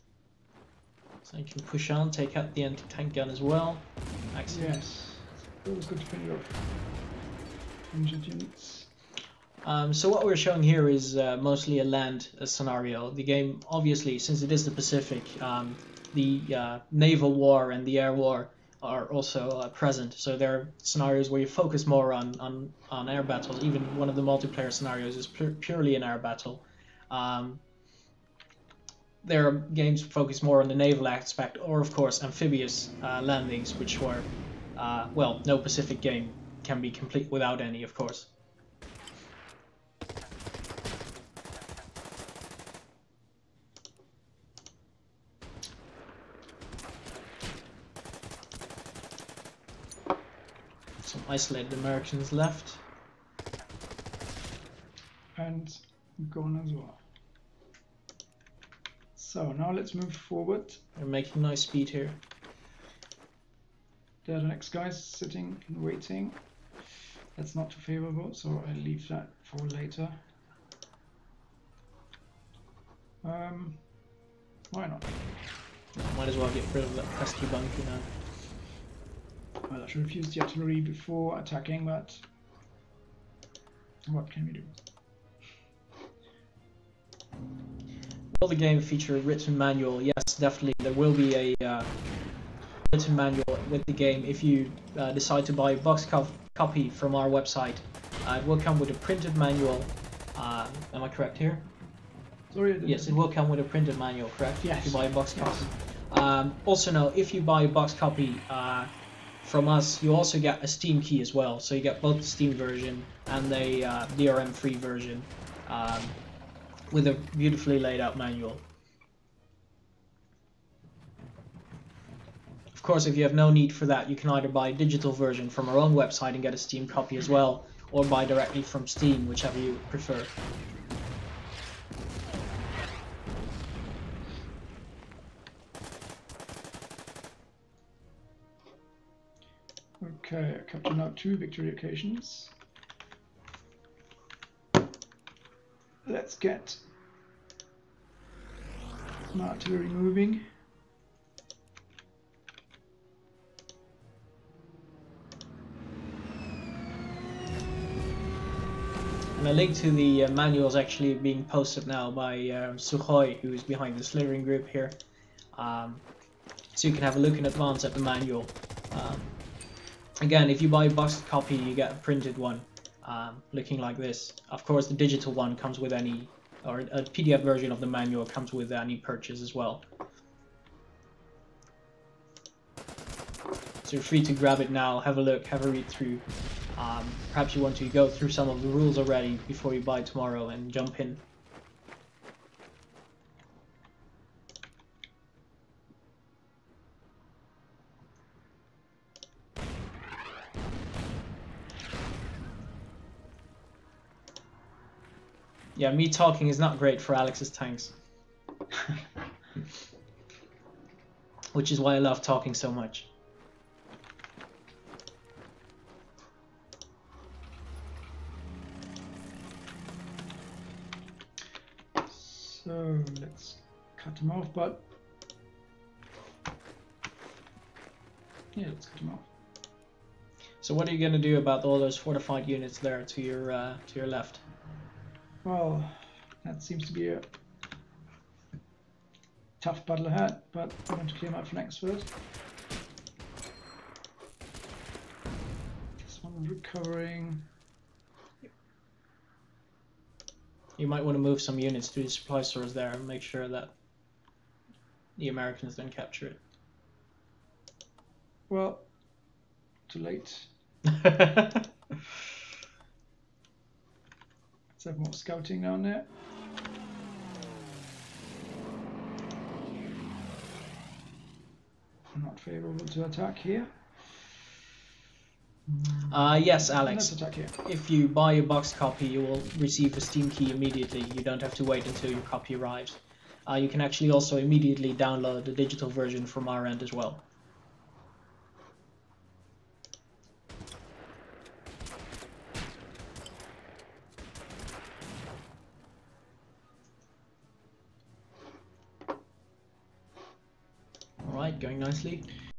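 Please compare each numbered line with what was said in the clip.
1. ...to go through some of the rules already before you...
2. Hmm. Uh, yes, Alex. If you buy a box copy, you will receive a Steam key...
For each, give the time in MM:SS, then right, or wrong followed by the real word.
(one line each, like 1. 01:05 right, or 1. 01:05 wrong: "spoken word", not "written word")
1. 03:07 right
2. 04:35 right.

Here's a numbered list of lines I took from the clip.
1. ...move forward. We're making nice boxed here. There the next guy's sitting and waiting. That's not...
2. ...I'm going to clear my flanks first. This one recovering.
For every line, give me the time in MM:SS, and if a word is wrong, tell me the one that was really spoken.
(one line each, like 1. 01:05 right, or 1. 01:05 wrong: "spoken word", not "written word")
1. 00:59 wrong: "speed", not "boxed"
2. 04:00 right.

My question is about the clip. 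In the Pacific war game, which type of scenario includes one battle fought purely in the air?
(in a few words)
multiplayer scenarios.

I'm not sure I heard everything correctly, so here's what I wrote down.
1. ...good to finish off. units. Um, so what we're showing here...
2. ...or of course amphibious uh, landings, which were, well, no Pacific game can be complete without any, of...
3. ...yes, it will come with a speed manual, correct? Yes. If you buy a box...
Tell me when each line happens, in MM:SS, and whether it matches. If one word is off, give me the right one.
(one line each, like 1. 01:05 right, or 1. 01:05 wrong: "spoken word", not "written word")
1. 00:05 right
2. 00:31 right
3. 01:42 wrong: "printed", not "speed".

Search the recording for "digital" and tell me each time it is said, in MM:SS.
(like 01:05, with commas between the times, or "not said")
02:04, 02:54, 04:45.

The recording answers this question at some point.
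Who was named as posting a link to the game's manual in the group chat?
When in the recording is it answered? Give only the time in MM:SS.
02:42.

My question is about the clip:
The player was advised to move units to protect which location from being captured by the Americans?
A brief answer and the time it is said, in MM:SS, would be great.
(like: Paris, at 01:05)
supply stores, at 04:12.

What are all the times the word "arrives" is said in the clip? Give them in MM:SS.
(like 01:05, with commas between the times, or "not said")
04:42.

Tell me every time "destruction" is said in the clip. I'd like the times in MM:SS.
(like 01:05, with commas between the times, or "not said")
not said.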